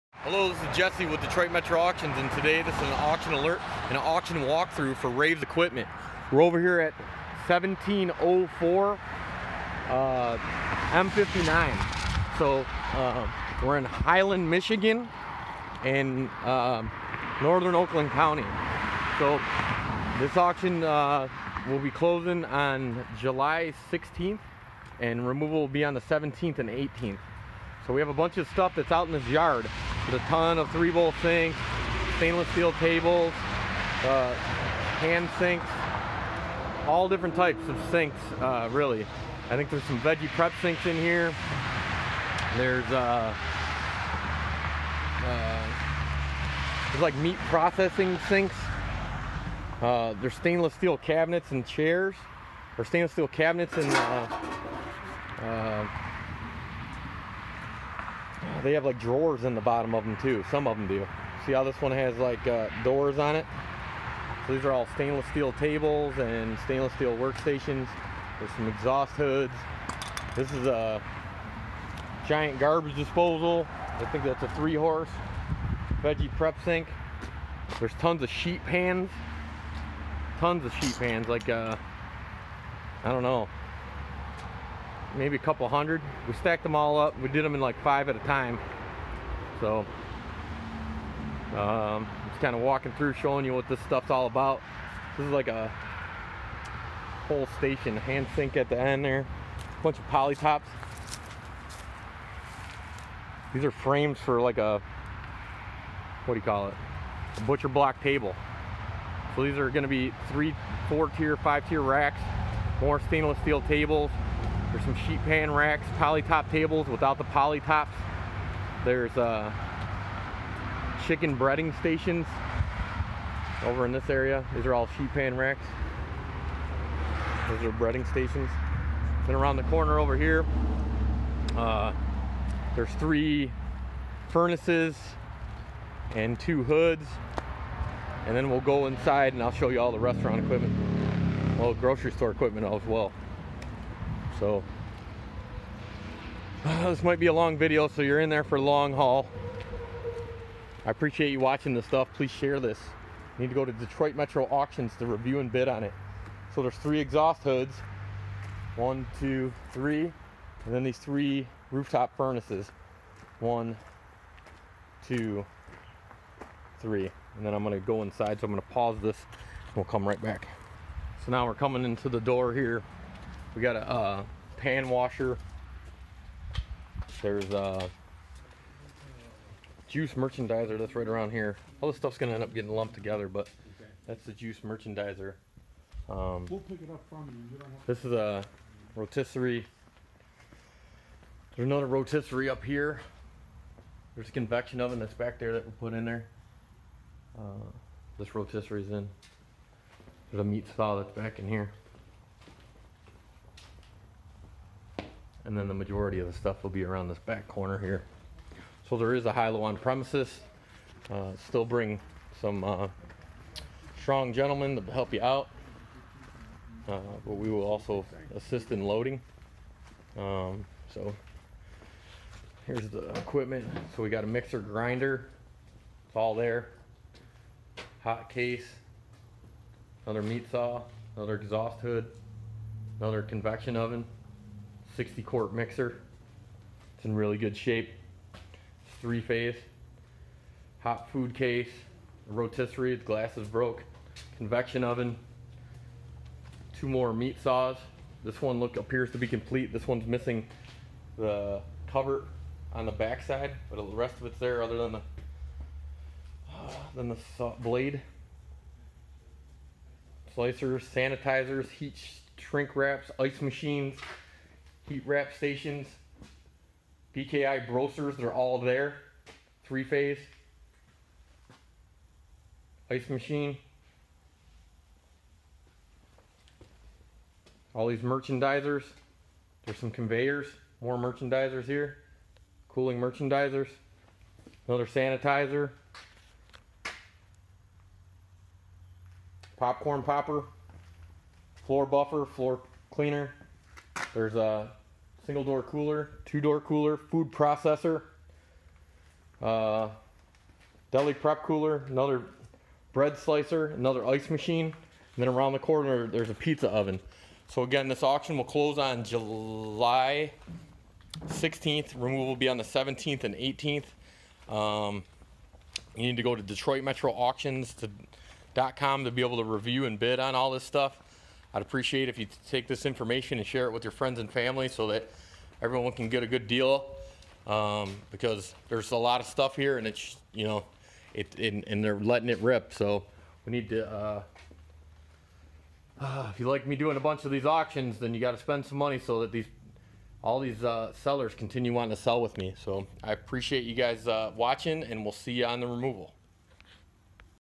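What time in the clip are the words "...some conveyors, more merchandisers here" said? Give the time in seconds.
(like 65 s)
279 s.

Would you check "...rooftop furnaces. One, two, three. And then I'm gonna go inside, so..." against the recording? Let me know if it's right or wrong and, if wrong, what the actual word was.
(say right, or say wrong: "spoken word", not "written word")
right.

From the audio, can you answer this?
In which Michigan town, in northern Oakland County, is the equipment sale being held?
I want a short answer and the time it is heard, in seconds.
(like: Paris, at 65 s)
Highland, at 13 s.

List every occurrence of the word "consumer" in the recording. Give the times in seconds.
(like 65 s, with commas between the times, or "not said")
not said.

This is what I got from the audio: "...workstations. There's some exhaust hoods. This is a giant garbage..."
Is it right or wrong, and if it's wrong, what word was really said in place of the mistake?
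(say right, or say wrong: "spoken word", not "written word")
right.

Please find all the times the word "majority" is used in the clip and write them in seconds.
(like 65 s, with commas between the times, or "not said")
205 s.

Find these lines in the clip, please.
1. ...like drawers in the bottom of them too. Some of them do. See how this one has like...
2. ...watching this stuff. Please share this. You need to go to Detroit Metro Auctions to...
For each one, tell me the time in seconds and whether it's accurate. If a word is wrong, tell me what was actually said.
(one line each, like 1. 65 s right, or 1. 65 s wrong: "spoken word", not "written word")
1. 58 s right
2. 151 s right.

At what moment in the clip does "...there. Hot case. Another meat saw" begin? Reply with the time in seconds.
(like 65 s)
226 s.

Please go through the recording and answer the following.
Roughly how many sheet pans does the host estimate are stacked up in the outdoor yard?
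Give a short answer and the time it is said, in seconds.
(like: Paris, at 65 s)
A couple hundred, at 85 s.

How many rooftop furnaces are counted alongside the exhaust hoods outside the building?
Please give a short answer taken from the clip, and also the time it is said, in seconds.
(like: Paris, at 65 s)
3, at 132 s.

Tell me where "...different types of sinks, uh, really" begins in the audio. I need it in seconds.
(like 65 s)
37 s.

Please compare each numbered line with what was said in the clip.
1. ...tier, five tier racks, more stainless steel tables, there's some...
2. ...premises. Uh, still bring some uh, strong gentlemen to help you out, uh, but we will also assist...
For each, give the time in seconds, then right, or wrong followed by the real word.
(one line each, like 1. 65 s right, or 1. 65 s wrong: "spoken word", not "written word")
1. 111 s right
2. 209 s right.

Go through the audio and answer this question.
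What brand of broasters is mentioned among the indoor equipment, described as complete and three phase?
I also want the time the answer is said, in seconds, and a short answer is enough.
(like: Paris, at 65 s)
BKI, at 267 s.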